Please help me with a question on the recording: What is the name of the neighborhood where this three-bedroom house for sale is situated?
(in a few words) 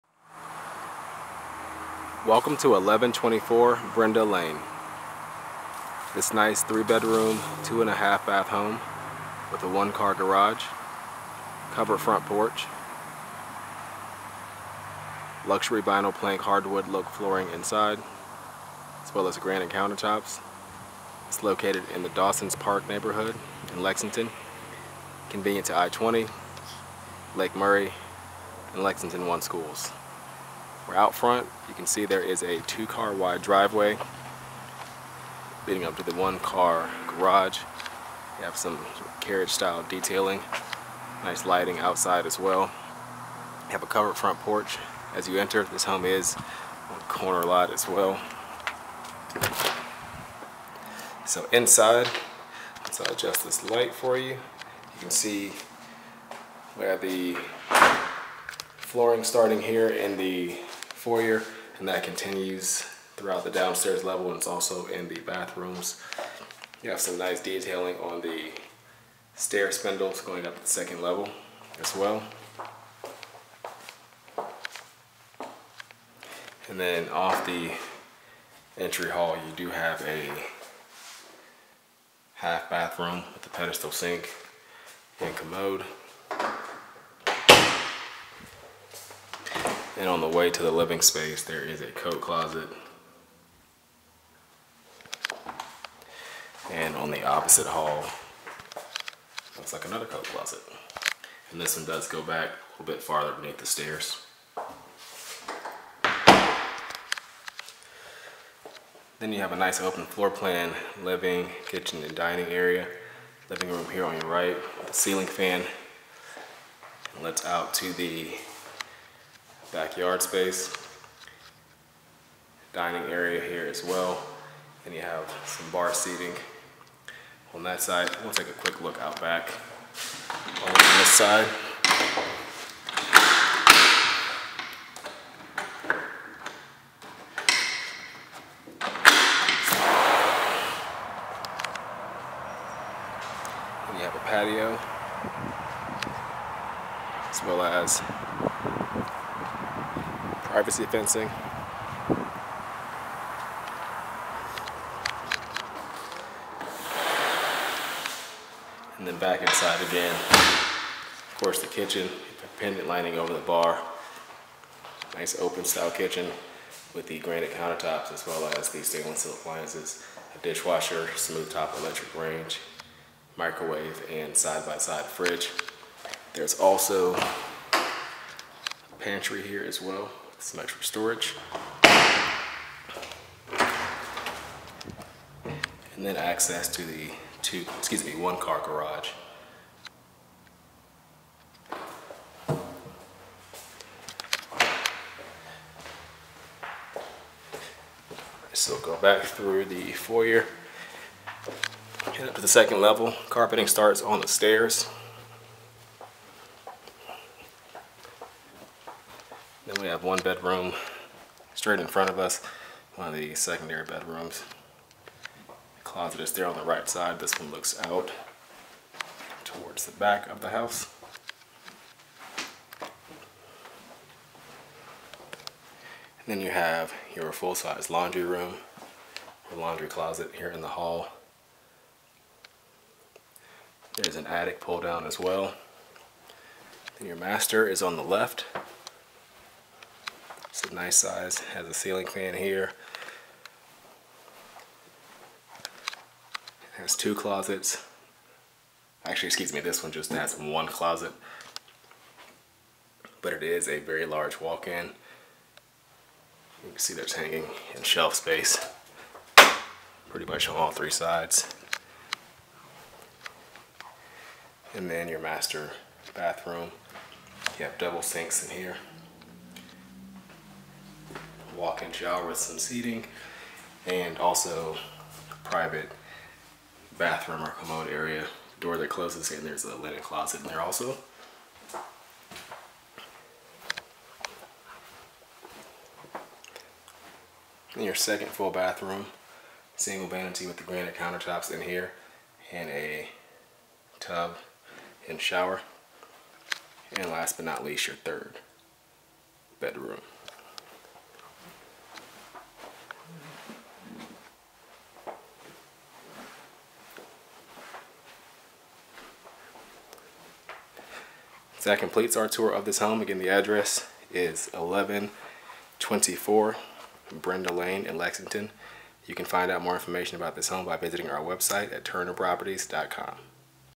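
Dawson's Park.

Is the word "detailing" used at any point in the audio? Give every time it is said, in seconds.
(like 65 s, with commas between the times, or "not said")
39 s, 67 s.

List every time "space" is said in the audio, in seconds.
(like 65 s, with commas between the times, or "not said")
91 s, 120 s, 258 s.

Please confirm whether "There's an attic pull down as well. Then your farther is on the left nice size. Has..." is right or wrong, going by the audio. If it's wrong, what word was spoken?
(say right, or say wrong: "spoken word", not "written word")
wrong: "master", not "farther".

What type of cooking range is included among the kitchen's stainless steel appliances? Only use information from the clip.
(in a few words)
Smooth top electric range.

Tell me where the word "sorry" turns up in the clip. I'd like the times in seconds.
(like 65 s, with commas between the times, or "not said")
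not said.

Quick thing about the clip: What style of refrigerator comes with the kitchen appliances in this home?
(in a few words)
Side-by-side.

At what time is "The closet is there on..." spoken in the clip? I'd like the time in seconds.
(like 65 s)
215 s.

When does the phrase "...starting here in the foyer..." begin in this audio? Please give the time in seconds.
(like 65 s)
59 s.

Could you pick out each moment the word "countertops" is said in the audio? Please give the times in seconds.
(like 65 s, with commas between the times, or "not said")
19 s, 167 s, 290 s.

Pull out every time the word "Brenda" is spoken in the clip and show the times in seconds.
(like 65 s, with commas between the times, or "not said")
3 s, 317 s.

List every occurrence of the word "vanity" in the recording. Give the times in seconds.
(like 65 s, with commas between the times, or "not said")
290 s.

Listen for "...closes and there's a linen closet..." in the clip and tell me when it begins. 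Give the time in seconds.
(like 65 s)
278 s.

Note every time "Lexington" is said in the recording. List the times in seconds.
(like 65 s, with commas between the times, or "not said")
23 s, 28 s, 317 s.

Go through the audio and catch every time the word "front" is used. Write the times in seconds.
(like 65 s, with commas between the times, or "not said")
11 s, 31 s, 44 s, 211 s.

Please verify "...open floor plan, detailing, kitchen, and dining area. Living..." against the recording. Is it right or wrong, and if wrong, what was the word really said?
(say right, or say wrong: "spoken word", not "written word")
wrong: "living", not "detailing".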